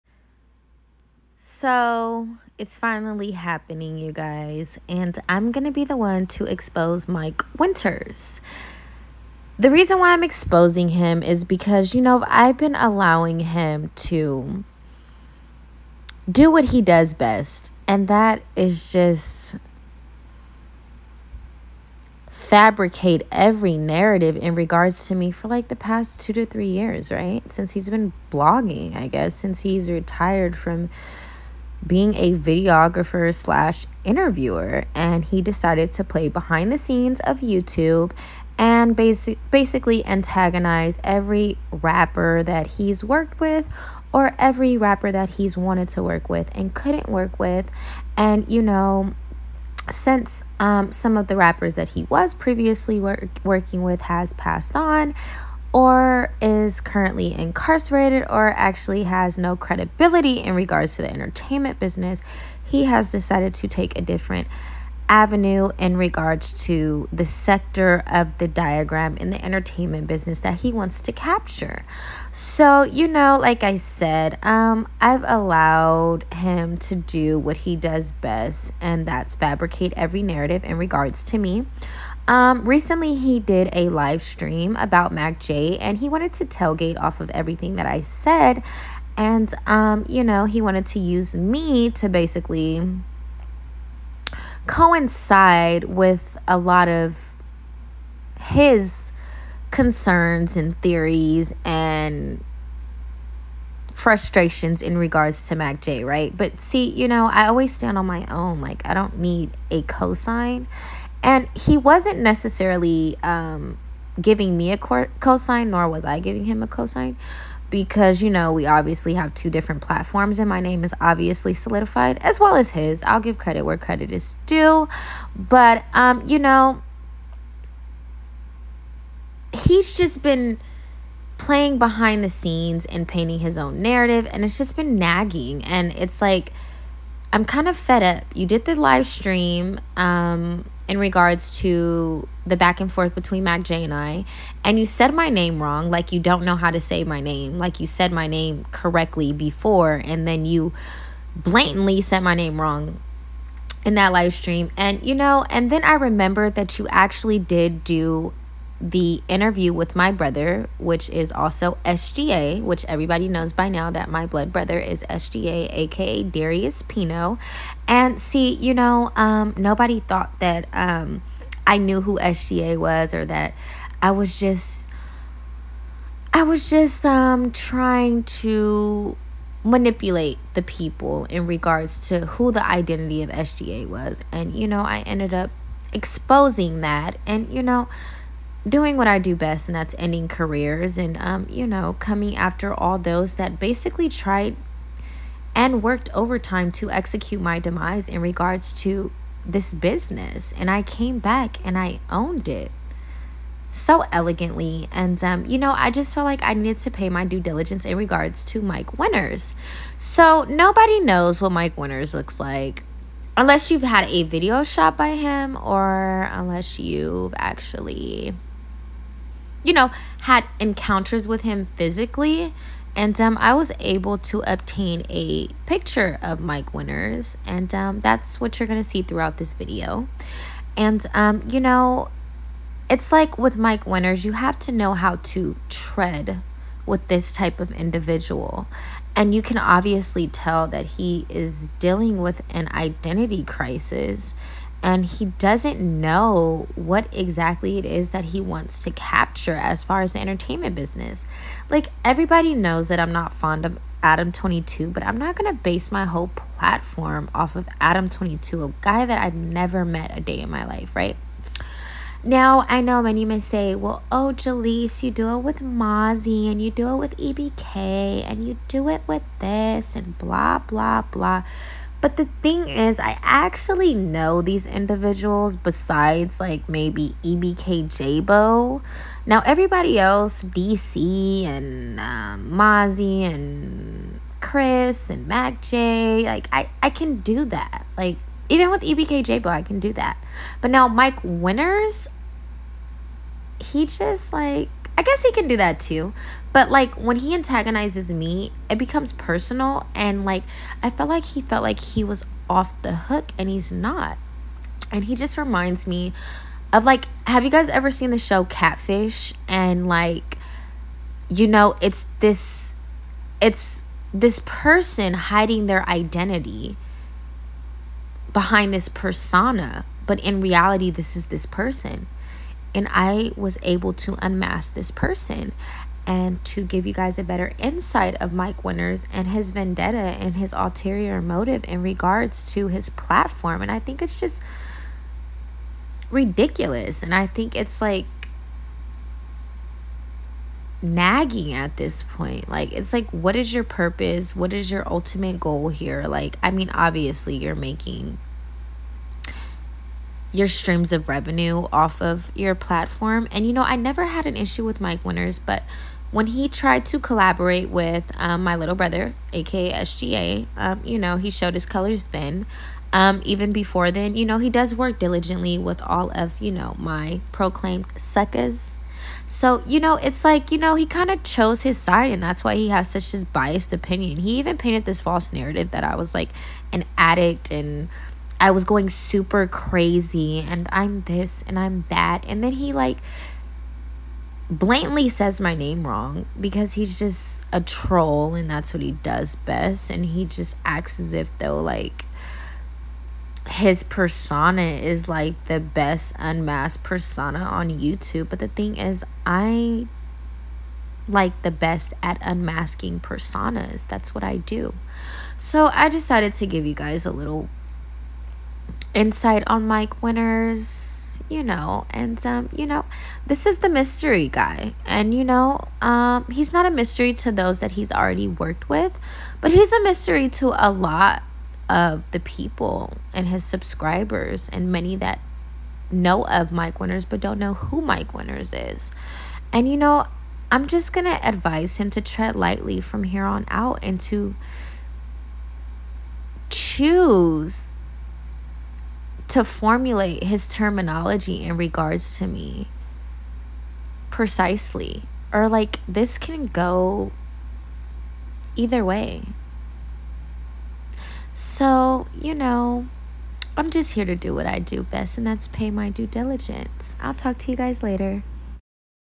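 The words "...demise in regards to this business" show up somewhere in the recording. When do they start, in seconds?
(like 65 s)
197 s.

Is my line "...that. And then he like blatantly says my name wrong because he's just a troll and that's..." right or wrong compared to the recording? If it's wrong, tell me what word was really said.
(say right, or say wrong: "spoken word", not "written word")
right.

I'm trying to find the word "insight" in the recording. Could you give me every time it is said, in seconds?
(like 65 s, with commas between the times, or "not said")
327 s, 408 s.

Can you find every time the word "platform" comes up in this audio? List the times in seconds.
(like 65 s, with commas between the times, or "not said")
119 s, 256 s, 332 s, 352 s.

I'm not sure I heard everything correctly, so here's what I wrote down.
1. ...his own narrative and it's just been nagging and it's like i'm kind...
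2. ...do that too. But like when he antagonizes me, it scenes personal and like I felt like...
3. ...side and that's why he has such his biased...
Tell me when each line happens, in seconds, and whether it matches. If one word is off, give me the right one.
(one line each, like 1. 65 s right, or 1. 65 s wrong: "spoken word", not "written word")
1. 133 s right
2. 295 s wrong: "becomes", not "scenes"
3. 371 s right.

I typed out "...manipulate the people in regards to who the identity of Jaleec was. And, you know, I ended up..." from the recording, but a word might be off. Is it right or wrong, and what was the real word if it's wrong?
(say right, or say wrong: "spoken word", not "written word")
wrong: "SGA", not "Jaleec".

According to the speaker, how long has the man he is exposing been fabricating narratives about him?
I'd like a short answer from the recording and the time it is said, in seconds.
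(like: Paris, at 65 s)
2 to 3 years, at 26 s.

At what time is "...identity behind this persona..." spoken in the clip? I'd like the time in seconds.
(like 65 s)
315 s.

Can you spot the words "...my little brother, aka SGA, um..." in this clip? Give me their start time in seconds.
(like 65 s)
358 s.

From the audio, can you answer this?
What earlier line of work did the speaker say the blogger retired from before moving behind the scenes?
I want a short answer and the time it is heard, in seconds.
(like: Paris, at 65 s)
videographer slash interviewer, at 32 s.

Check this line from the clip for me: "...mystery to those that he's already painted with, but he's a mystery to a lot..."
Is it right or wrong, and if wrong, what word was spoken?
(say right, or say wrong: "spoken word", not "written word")
wrong: "worked", not "painted".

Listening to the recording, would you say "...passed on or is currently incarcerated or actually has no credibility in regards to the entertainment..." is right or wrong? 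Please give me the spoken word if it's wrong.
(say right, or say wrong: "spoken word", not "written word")
right.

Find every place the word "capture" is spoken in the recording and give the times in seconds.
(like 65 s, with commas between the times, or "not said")
71 s, 248 s.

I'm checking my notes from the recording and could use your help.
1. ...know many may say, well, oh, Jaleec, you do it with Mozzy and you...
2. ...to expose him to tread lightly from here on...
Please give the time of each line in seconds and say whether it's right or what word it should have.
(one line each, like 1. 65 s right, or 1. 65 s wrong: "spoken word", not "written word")
1. 262 s right
2. 431 s wrong: "advise", not "expose".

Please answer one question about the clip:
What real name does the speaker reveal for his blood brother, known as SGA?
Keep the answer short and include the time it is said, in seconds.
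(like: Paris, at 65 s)
Darius Pino, at 166 s.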